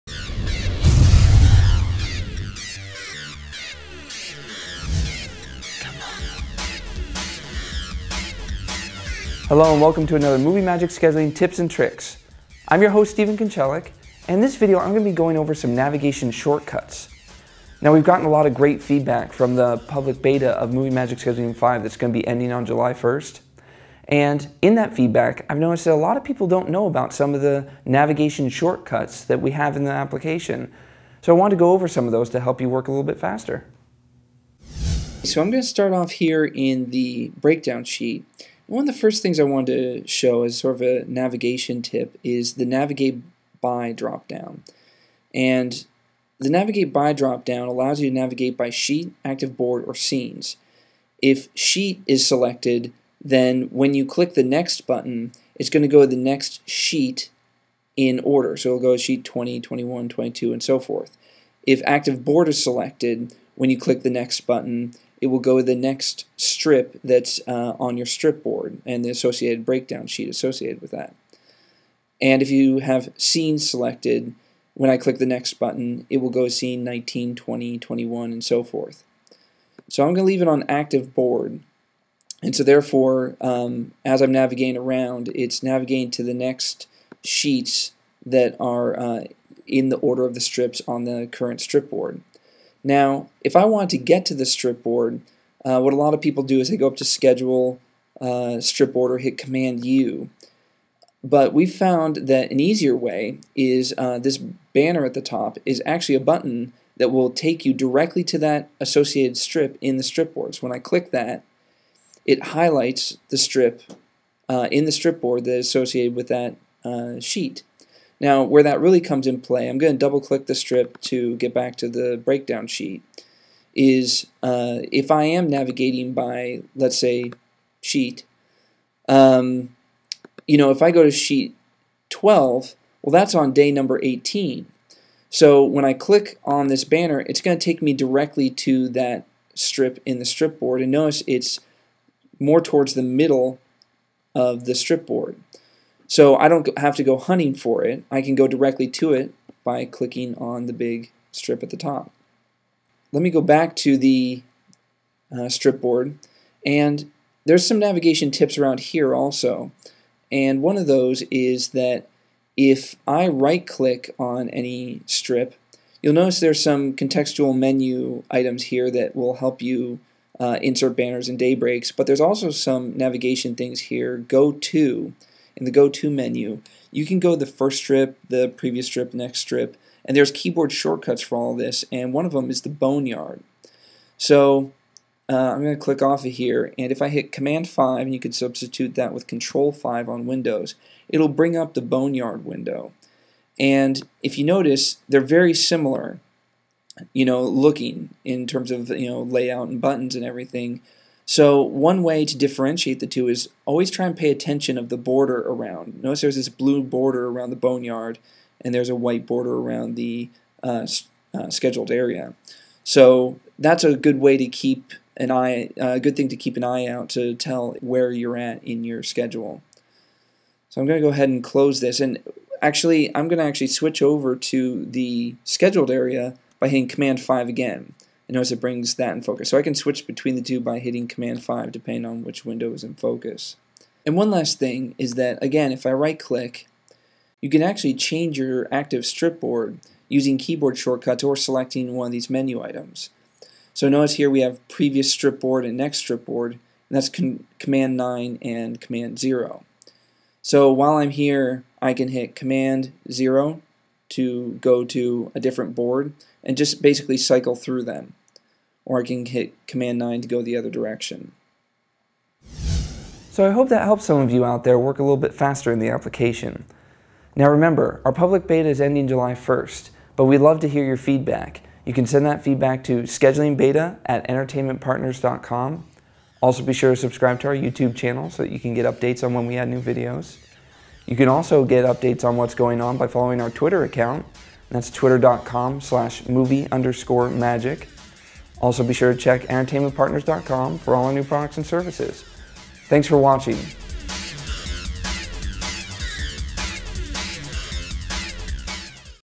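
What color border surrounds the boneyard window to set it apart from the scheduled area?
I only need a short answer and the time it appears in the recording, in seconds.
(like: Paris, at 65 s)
Blue, at 206 s.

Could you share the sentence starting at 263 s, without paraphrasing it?
So I hope that helps some of you out there work a little bit faster in the application.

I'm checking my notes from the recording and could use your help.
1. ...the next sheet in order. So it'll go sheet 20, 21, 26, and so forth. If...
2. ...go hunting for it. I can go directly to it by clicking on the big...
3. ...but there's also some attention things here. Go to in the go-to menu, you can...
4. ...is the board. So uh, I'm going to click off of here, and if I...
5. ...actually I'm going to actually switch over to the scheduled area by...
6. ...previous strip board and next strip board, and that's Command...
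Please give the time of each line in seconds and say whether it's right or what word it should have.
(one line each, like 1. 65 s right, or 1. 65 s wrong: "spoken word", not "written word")
1. 56 s wrong: "22", not "26"
2. 147 s right
3. 171 s wrong: "navigation", not "attention"
4. 182 s wrong: "boneyard", not "board"
5. 222 s right
6. 244 s right.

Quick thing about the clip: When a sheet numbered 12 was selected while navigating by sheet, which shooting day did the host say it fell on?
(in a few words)
Day 18.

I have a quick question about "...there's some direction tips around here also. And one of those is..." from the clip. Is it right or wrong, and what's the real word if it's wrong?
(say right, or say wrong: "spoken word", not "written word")
wrong: "navigation", not "direction".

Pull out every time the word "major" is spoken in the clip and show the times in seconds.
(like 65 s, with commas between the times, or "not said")
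not said.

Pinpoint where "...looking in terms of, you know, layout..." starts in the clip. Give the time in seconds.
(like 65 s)
197 s.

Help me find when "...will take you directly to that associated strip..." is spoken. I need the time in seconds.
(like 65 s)
107 s.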